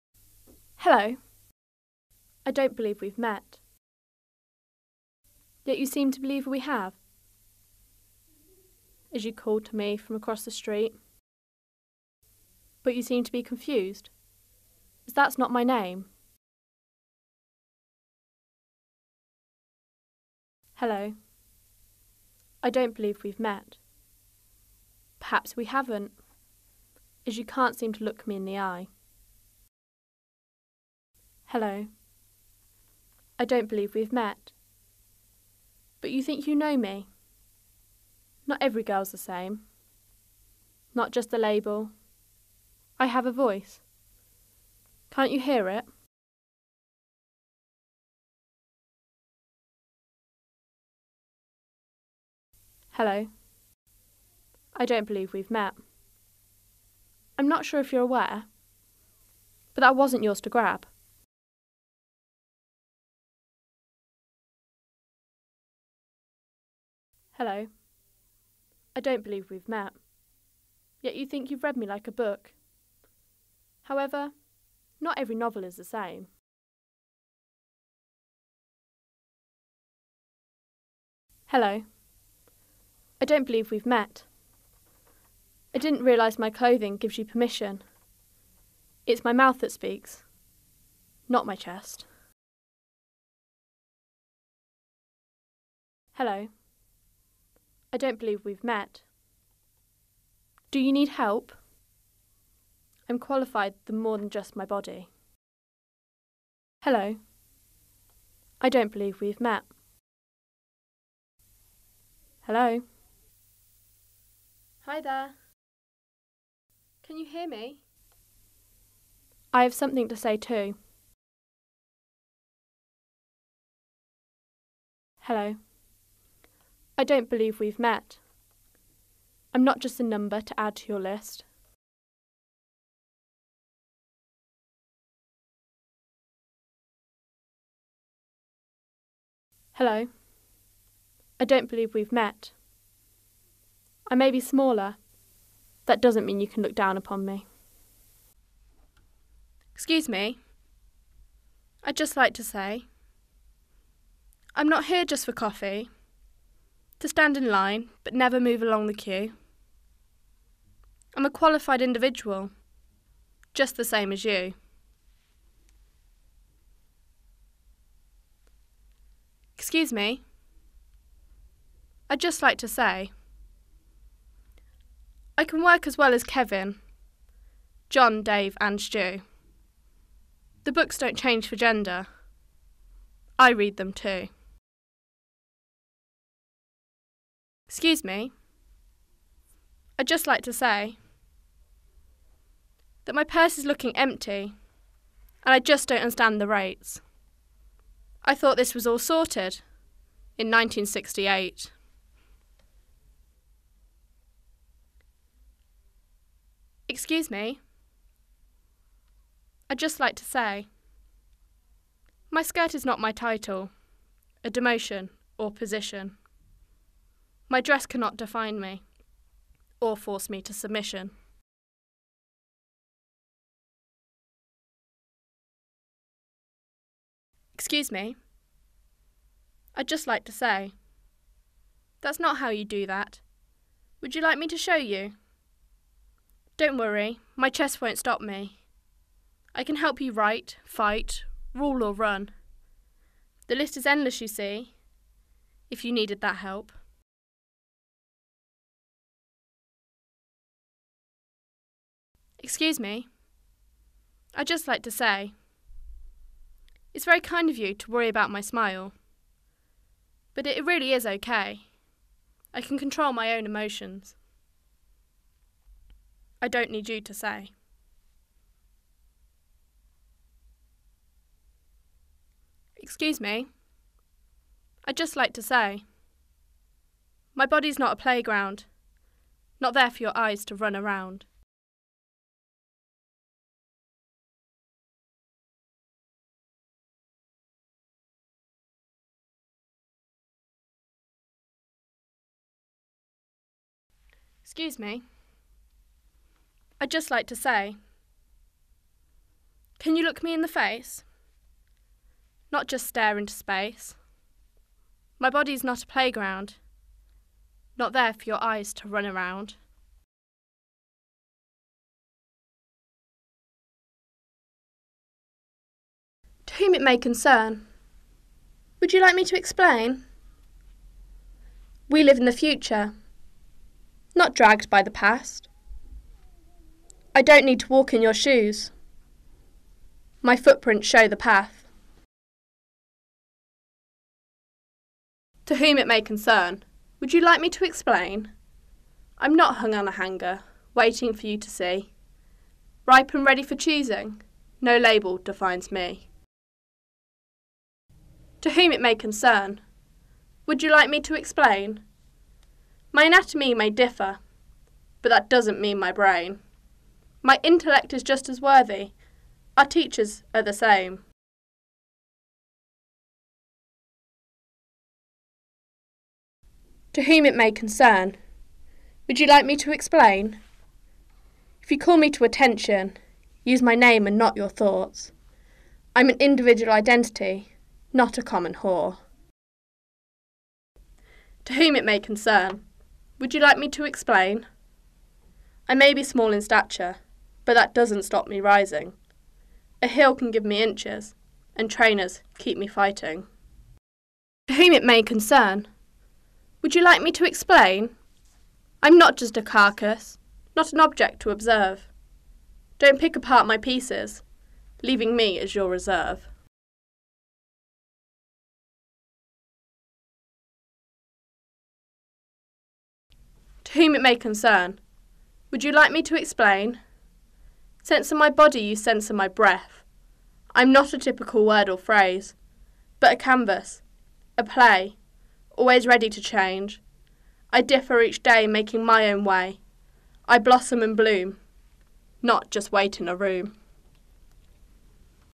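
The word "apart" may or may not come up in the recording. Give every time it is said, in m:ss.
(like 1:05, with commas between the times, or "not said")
6:43.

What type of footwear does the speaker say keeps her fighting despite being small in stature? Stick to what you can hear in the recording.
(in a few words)
Trainers.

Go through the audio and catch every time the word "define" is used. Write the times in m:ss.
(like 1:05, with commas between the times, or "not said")
3:38, 5:45.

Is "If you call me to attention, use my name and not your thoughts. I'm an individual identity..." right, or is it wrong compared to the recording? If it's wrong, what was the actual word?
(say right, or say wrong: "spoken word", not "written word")
right.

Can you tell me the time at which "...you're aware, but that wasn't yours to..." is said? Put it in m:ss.
0:57.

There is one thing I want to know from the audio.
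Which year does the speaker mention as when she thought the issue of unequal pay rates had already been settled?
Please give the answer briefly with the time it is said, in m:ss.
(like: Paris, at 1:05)
1968, at 3:20.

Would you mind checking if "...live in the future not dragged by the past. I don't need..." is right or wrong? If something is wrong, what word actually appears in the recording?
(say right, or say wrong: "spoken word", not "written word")
right.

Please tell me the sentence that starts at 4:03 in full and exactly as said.
The list is endless, you see, if you needed that help.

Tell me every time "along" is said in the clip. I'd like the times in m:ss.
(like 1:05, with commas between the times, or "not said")
2:38.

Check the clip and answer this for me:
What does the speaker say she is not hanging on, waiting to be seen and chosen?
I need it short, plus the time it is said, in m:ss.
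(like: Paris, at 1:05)
A hanger, at 5:39.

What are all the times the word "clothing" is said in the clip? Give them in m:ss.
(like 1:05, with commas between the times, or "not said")
1:26.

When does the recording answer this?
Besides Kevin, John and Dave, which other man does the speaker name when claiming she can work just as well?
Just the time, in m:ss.
2:58.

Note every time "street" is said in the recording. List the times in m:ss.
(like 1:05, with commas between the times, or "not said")
0:10.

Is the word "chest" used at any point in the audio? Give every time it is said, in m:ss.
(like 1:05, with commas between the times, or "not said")
1:31, 3:57.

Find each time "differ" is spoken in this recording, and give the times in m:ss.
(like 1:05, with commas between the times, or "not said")
5:53, 7:07.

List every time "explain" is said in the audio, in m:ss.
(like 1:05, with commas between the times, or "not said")
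5:19, 5:37, 5:51, 6:09, 6:23, 6:37, 6:56.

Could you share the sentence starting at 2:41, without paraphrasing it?
I'm a qualified individual, just the same as you.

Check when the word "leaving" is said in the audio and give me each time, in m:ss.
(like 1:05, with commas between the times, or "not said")
6:44.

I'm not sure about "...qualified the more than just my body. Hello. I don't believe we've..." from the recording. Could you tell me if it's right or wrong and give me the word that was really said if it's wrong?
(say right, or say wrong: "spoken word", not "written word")
right.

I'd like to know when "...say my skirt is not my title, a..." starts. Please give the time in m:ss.
3:30.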